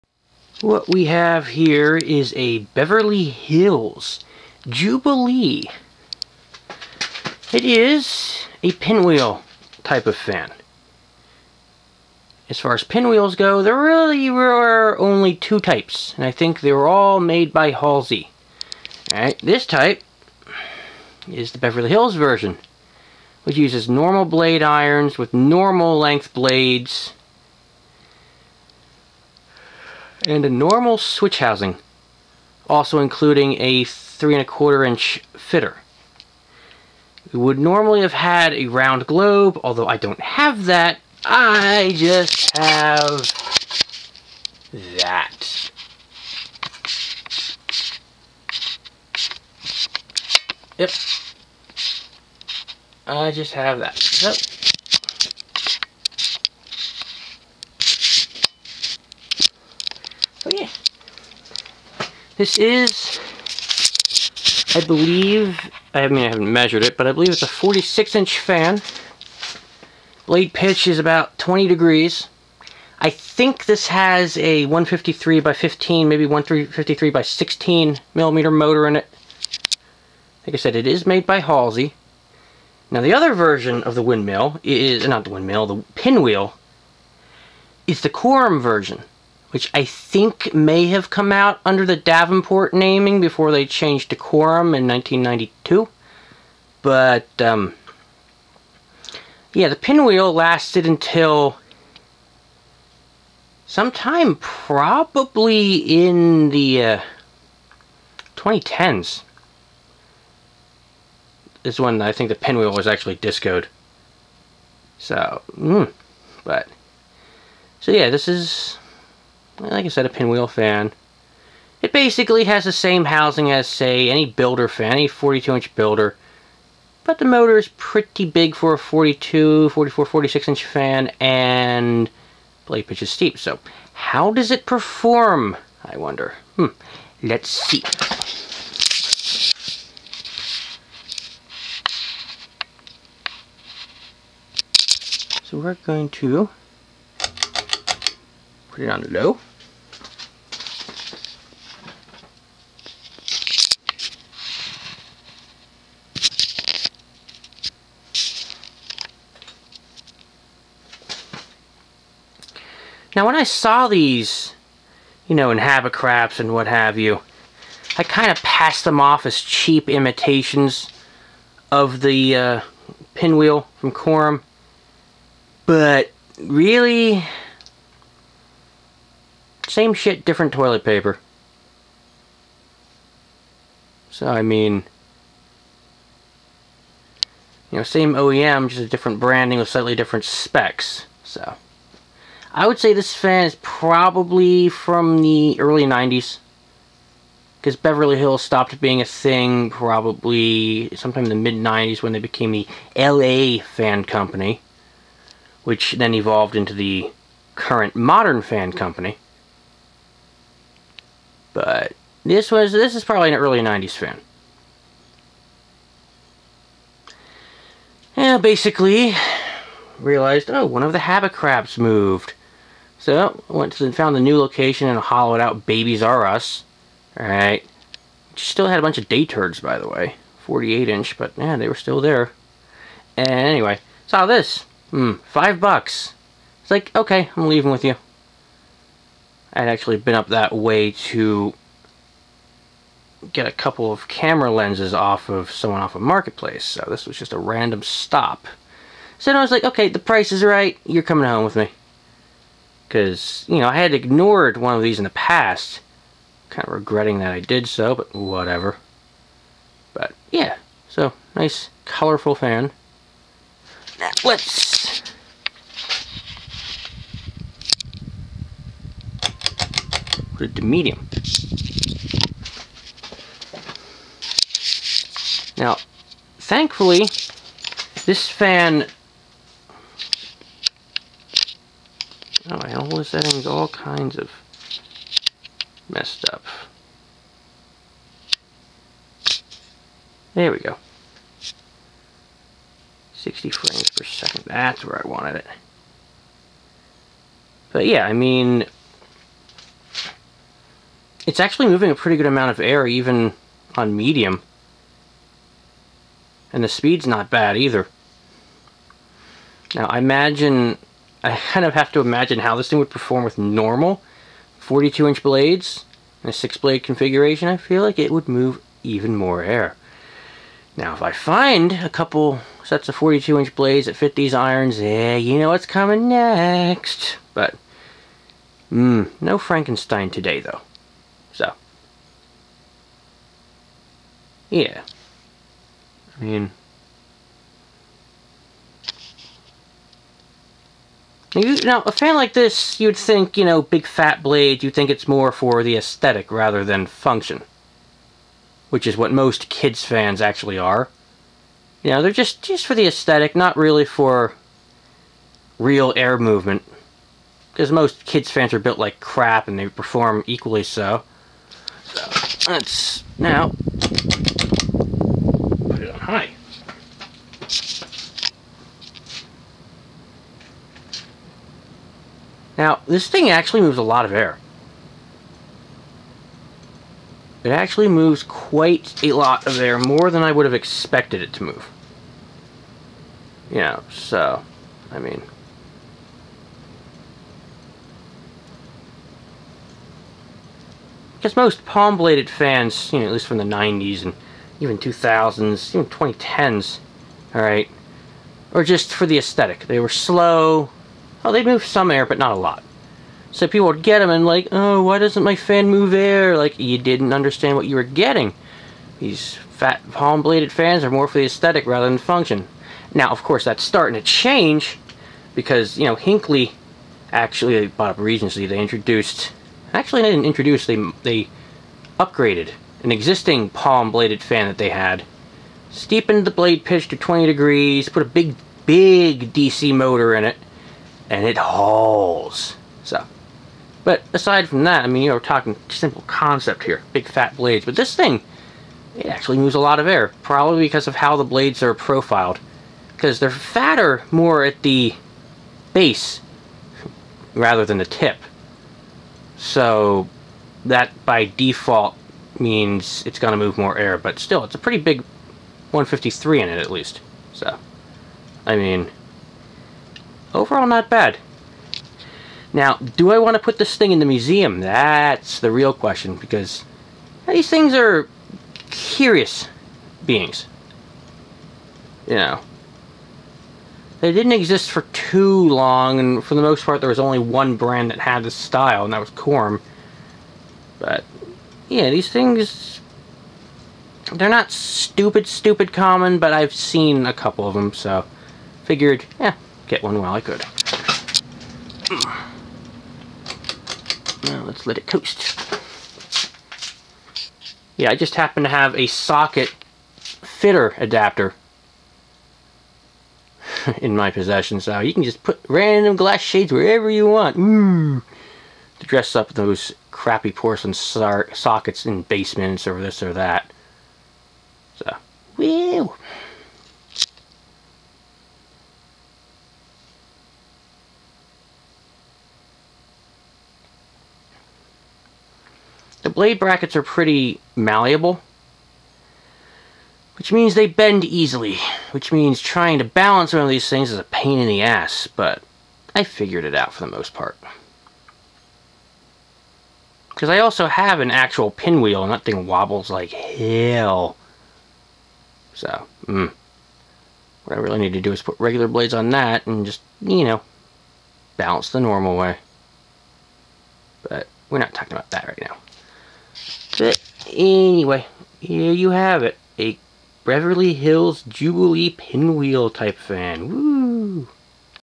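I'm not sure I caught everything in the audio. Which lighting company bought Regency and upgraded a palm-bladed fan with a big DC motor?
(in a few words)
Hinkley.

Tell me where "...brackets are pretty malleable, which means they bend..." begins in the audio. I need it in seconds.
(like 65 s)
526 s.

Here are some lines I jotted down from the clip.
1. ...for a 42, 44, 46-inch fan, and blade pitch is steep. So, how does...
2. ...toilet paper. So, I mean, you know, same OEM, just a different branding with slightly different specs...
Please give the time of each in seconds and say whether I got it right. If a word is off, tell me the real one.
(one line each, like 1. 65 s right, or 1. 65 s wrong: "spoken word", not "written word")
1. 128 s right
2. 180 s right.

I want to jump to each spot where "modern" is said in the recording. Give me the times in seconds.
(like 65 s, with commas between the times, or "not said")
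207 s.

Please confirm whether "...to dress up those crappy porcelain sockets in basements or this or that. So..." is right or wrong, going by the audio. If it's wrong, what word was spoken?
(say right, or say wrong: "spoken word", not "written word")
right.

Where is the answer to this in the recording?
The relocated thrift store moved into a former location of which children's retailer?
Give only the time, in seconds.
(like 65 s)
225 s.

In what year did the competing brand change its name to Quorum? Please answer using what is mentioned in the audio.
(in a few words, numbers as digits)
1992.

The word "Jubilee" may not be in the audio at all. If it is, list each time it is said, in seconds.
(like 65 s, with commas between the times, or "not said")
4 s, 561 s.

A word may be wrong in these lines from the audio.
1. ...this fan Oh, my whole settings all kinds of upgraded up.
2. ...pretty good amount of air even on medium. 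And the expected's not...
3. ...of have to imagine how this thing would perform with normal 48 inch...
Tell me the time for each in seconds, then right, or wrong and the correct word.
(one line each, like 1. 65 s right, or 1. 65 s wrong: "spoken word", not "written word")
1. 278 s wrong: "messed", not "upgraded"
2. 301 s wrong: "speed", not "expected"
3. 311 s wrong: "42", not "48".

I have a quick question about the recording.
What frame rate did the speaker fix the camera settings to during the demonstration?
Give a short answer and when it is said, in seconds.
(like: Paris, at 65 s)
60 frames per second, at 293 s.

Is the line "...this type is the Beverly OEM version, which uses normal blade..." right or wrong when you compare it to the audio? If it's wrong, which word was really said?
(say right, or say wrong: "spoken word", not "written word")
wrong: "Hills", not "OEM".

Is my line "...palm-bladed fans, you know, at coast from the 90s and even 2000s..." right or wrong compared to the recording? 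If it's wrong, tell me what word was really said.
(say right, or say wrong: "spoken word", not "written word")
wrong: "least", not "coast".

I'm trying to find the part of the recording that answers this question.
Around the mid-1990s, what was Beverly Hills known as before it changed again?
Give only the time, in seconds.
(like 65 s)
202 s.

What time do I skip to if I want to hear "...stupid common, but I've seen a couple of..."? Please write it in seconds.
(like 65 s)
485 s.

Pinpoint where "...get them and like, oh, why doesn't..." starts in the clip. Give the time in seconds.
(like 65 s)
403 s.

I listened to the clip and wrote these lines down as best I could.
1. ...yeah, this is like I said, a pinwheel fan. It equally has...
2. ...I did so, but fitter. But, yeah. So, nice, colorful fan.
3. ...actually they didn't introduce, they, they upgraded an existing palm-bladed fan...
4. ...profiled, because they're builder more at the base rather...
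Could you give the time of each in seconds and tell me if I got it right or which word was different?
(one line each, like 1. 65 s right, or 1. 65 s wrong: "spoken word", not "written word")
1. 117 s wrong: "basically", not "equally"
2. 257 s wrong: "whatever", not "fitter"
3. 419 s right
4. 441 s wrong: "fatter", not "builder".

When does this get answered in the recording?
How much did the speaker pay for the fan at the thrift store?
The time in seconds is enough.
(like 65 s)
235 s.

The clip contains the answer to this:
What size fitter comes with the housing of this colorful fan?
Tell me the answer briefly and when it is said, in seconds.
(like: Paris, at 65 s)
3 and a quarter inch, at 33 s.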